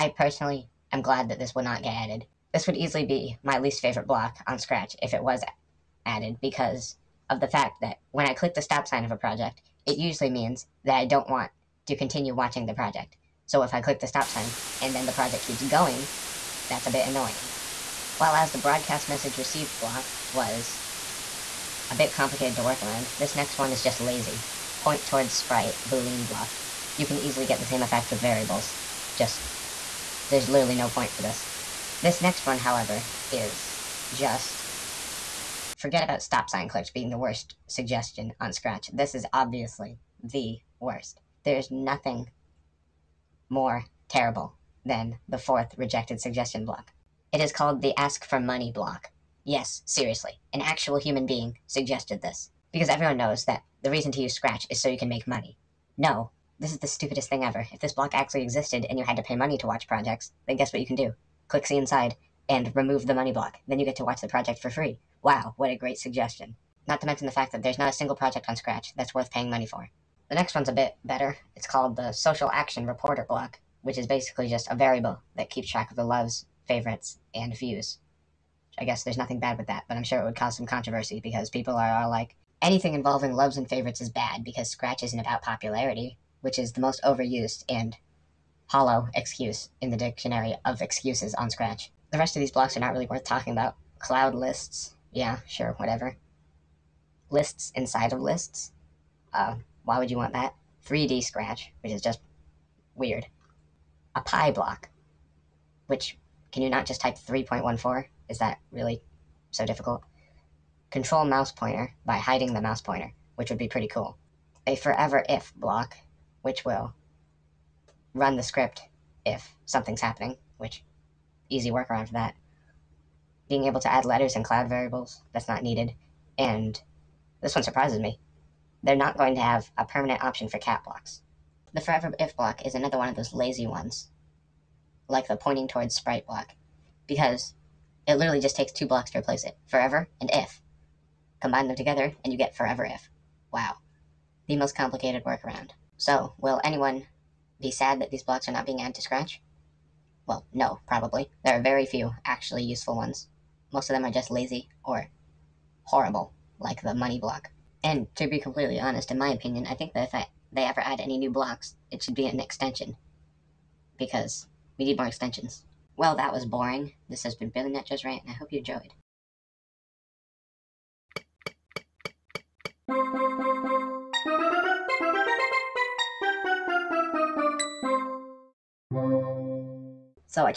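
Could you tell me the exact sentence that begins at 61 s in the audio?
Click see inside and remove the money block.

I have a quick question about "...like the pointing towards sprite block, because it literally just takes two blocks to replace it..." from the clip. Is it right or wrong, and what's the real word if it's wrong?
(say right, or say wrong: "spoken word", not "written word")
right.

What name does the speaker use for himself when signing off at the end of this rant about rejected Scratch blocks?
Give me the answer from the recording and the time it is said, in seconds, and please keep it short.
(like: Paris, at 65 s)
Billy Nut Joe, at 167 s.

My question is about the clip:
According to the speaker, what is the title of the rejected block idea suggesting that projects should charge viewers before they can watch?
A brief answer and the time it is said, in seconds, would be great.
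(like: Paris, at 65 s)
ask for money block, at 47 s.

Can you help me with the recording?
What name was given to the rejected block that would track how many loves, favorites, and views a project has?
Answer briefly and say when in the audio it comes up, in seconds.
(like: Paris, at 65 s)
Social Action Reporter block, at 72 s.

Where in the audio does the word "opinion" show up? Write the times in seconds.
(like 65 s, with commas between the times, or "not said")
159 s.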